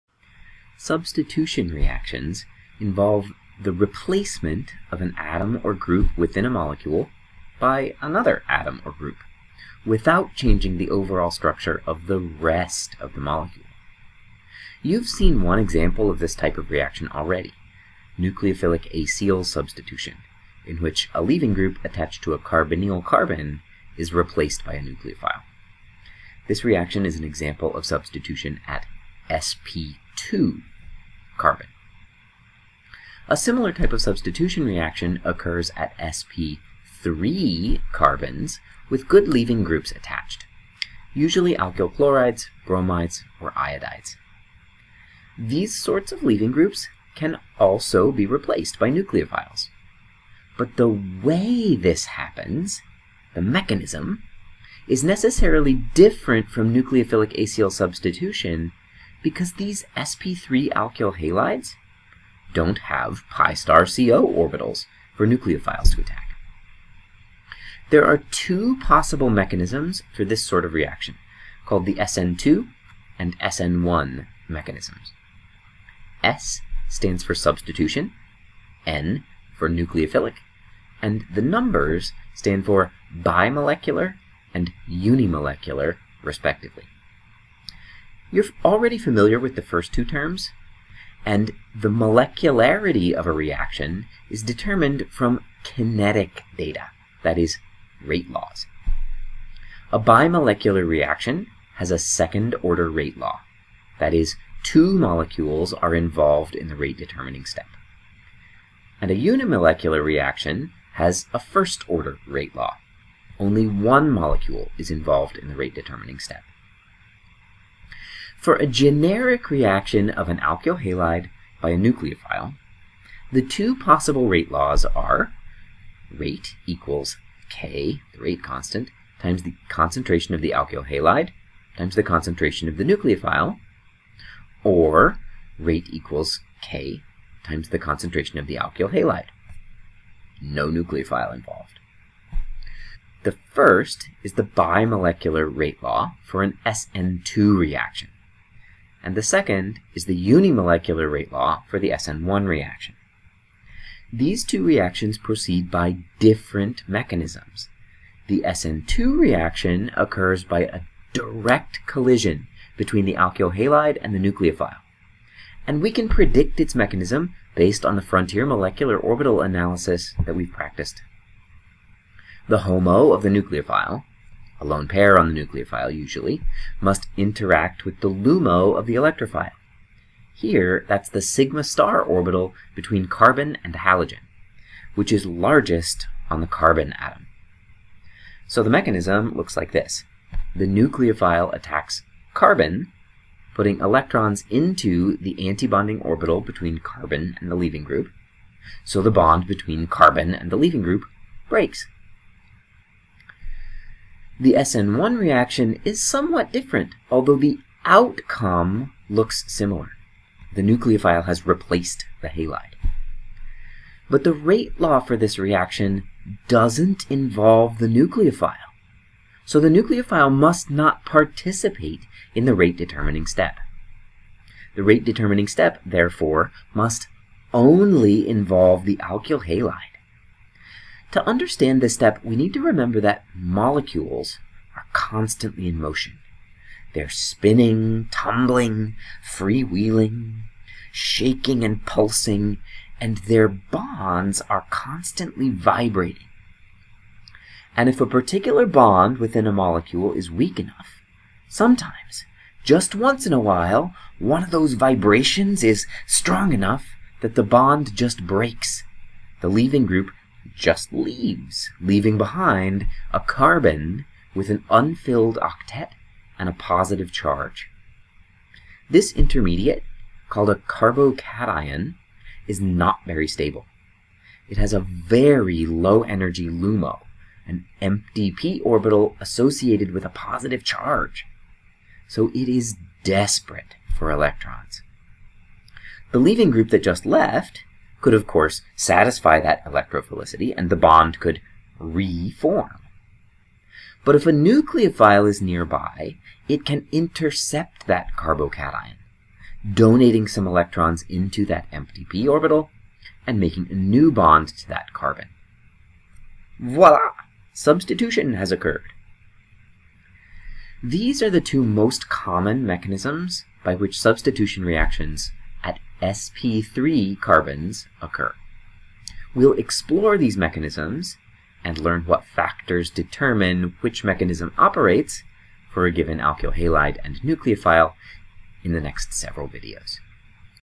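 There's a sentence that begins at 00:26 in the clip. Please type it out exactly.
This reaction is an example of substitution at sp2 carbon.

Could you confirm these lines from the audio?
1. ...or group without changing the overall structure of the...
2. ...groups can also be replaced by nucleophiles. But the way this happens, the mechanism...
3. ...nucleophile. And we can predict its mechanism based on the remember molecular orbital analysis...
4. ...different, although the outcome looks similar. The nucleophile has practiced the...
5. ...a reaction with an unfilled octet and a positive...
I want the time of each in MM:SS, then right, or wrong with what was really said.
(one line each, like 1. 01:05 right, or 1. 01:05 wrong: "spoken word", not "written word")
1. 00:08 right
2. 00:46 right
3. 02:44 wrong: "frontier", not "remember"
4. 03:26 wrong: "replaced", not "practiced"
5. 04:23 wrong: "carbon", not "reaction".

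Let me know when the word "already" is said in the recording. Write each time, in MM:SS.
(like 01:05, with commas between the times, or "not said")
00:17, 01:28.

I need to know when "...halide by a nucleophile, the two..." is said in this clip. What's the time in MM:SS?
02:00.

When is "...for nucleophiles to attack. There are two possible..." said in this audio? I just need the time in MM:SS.
01:05.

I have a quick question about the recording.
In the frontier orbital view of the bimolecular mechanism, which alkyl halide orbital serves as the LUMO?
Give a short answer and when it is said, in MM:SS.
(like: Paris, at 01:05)
sigma star orbital, at 03:01.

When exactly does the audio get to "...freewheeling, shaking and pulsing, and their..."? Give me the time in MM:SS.
03:59.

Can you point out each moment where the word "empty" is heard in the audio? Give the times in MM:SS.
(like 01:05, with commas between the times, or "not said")
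04:37, 05:01.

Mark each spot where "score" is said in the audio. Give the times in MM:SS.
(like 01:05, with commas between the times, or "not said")
not said.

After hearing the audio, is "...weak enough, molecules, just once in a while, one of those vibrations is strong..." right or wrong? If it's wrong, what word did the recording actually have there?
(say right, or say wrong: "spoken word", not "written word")
wrong: "sometimes", not "molecules".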